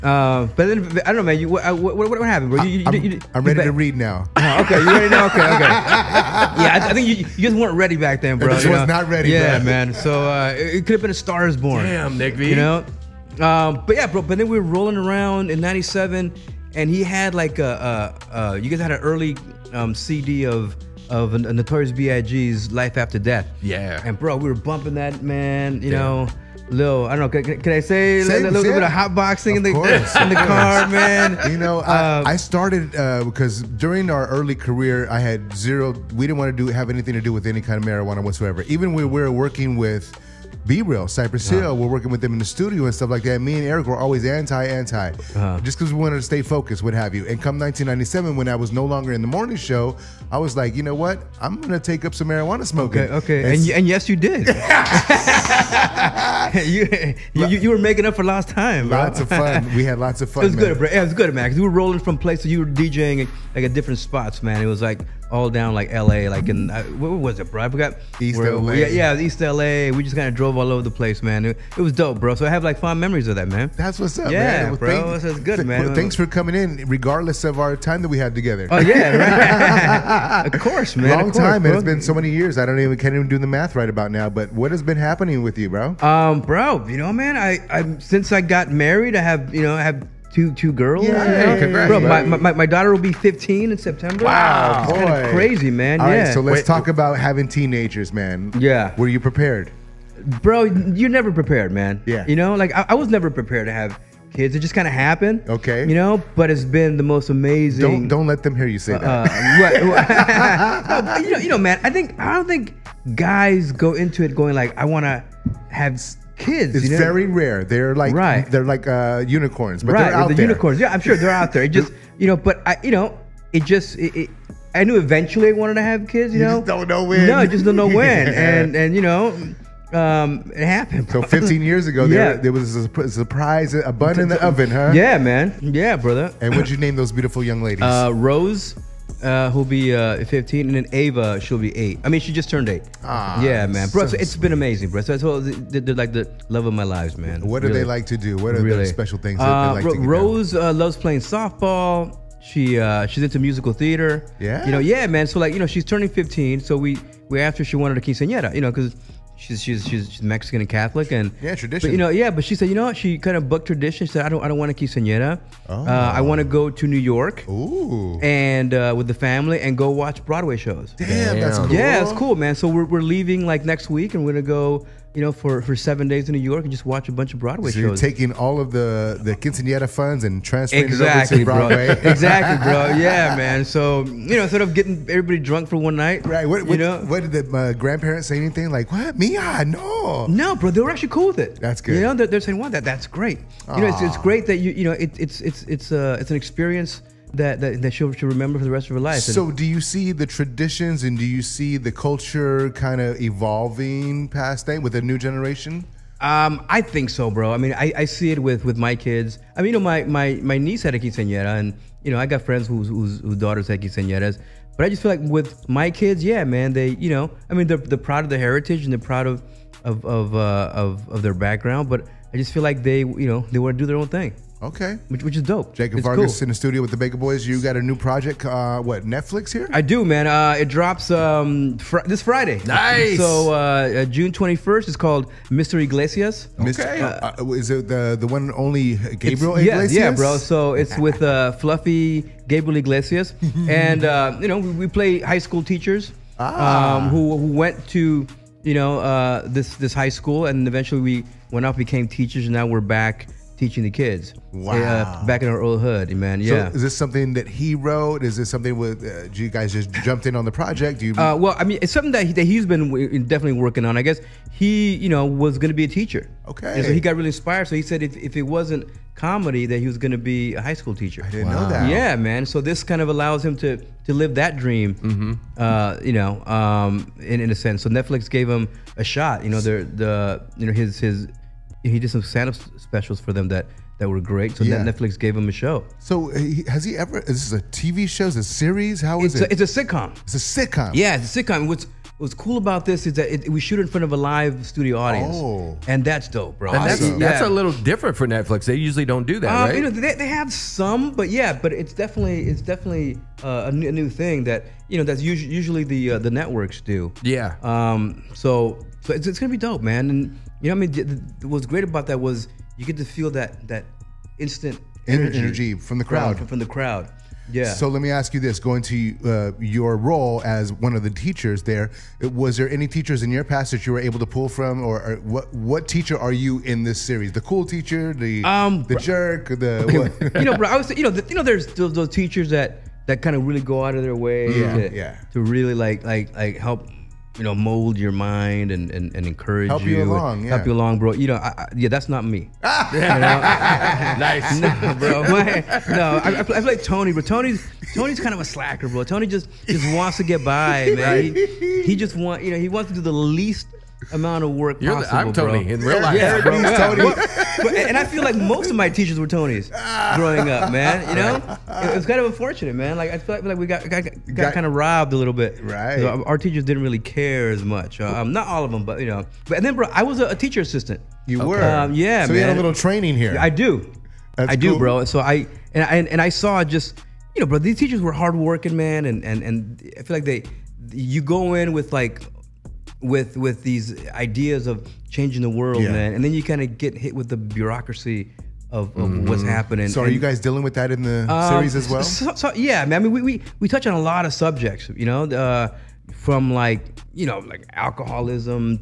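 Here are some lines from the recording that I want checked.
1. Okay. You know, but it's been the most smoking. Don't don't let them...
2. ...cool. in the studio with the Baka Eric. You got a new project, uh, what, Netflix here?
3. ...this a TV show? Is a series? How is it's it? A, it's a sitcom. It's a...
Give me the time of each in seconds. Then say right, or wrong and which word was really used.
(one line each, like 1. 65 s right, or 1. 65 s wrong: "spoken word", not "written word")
1. 105 s wrong: "amazing", not "smoking"
2. 226 s wrong: "Boyz", not "Eric"
3. 287 s right.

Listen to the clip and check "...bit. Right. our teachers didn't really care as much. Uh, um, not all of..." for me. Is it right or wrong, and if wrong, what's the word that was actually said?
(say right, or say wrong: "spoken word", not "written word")
right.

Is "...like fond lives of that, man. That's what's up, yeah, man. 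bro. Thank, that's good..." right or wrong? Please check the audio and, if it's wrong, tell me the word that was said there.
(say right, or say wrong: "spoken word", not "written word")
wrong: "memories", not "lives".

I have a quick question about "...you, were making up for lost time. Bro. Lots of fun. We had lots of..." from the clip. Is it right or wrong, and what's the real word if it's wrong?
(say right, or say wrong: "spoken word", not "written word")
right.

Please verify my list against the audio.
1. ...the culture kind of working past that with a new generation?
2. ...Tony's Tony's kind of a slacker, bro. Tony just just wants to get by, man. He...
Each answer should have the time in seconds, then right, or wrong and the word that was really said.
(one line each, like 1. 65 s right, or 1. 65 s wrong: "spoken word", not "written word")
1. 201 s wrong: "evolving", not "working"
2. 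347 s right.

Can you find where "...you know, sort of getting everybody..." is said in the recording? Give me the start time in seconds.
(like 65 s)
184 s.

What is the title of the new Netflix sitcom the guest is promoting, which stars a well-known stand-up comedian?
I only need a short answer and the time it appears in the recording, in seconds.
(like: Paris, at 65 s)
Mr. Iglesias, at 235 s.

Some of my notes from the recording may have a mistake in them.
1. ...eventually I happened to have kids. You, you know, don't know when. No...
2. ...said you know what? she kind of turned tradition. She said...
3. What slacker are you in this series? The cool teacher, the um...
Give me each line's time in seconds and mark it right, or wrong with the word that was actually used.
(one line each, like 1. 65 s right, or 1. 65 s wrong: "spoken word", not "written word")
1. 124 s wrong: "wanted", not "happened"
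2. 162 s wrong: "booked", not "turned"
3. 325 s wrong: "teacher", not "slacker".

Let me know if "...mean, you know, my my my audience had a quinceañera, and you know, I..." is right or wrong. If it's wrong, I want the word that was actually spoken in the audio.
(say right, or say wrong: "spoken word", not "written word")
wrong: "niece", not "audience".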